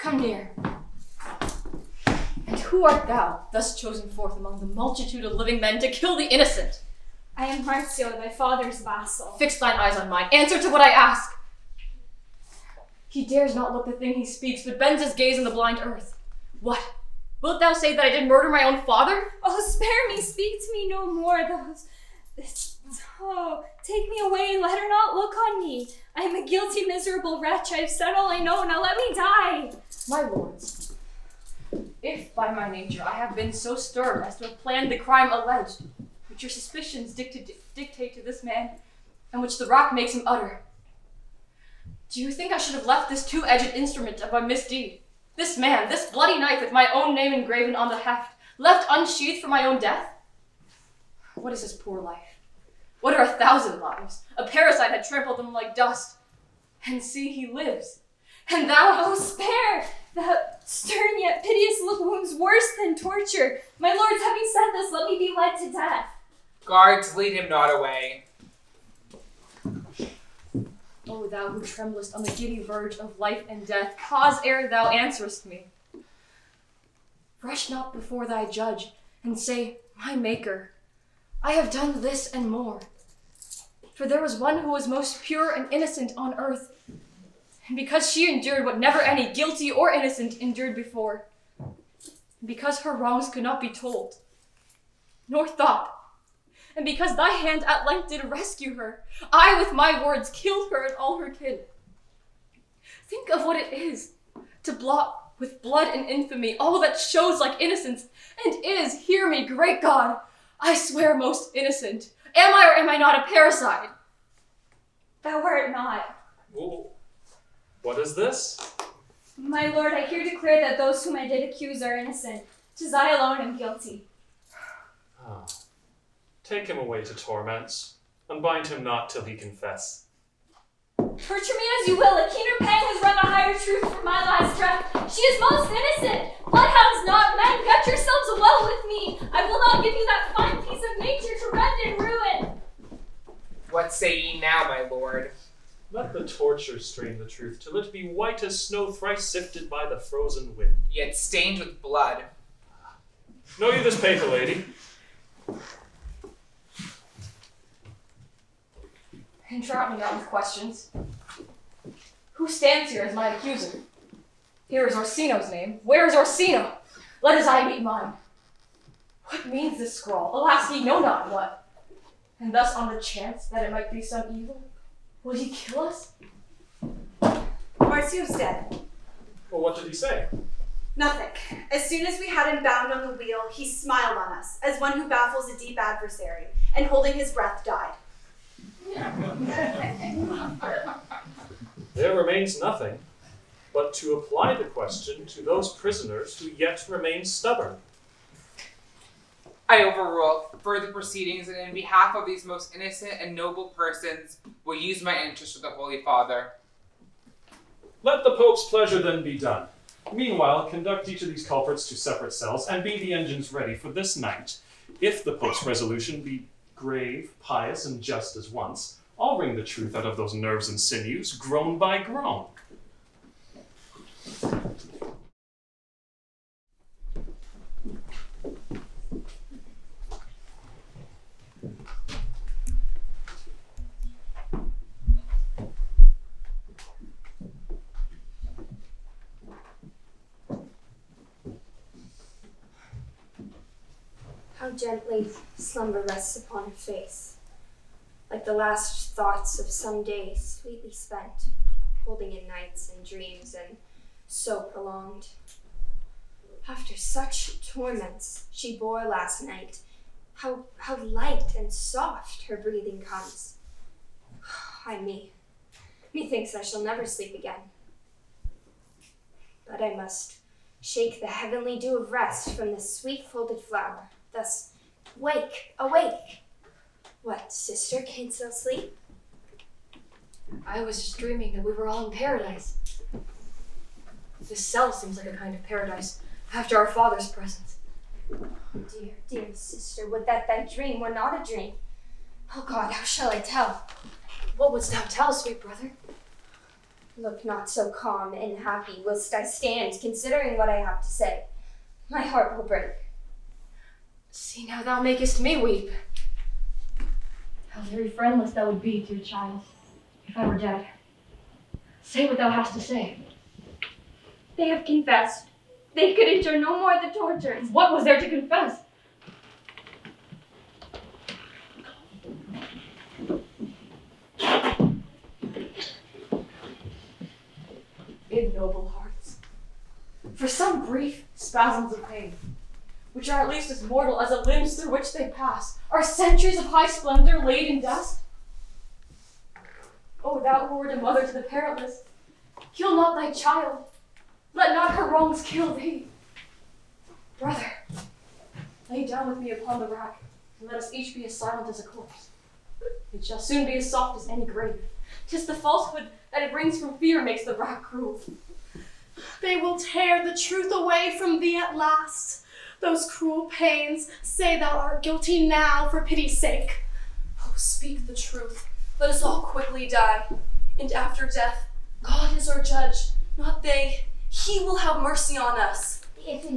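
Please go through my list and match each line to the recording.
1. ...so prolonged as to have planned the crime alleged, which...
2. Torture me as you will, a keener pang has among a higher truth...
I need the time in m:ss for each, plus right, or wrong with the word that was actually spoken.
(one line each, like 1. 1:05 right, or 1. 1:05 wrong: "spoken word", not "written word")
1. 0:33 wrong: "stirred", not "prolonged"
2. 2:10 wrong: "wrung", not "among".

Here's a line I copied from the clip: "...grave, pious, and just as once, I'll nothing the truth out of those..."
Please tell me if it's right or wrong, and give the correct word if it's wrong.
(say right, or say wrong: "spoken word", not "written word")
wrong: "wring", not "nothing".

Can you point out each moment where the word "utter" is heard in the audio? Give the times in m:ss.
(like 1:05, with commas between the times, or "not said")
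0:40.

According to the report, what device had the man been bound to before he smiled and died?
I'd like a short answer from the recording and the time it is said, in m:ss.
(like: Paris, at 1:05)
the wheel, at 3:03.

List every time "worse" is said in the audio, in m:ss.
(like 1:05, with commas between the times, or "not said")
1:02.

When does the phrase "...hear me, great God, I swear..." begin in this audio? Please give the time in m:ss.
1:49.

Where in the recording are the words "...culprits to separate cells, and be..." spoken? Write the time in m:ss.
3:31.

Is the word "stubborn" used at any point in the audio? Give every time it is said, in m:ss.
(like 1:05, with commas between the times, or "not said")
3:17.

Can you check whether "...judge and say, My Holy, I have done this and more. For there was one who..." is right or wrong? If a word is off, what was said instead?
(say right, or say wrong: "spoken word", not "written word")
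wrong: "Maker", not "Holy".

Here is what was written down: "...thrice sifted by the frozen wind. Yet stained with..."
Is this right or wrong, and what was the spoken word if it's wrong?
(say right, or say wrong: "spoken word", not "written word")
right.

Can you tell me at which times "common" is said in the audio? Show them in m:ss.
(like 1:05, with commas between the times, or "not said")
not said.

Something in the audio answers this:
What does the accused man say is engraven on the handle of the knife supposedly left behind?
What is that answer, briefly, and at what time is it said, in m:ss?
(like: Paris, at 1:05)
my own name, at 0:46.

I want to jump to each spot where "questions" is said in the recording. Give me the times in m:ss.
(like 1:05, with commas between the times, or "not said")
2:40, 3:14.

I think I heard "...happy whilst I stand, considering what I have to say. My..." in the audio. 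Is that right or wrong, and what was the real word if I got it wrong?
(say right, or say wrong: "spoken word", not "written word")
right.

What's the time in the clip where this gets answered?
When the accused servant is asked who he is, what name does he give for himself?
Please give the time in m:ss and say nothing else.
0:07.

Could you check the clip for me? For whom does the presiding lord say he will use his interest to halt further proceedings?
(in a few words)
the Holy Father.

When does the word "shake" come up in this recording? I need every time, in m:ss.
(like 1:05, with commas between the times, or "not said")
4:30.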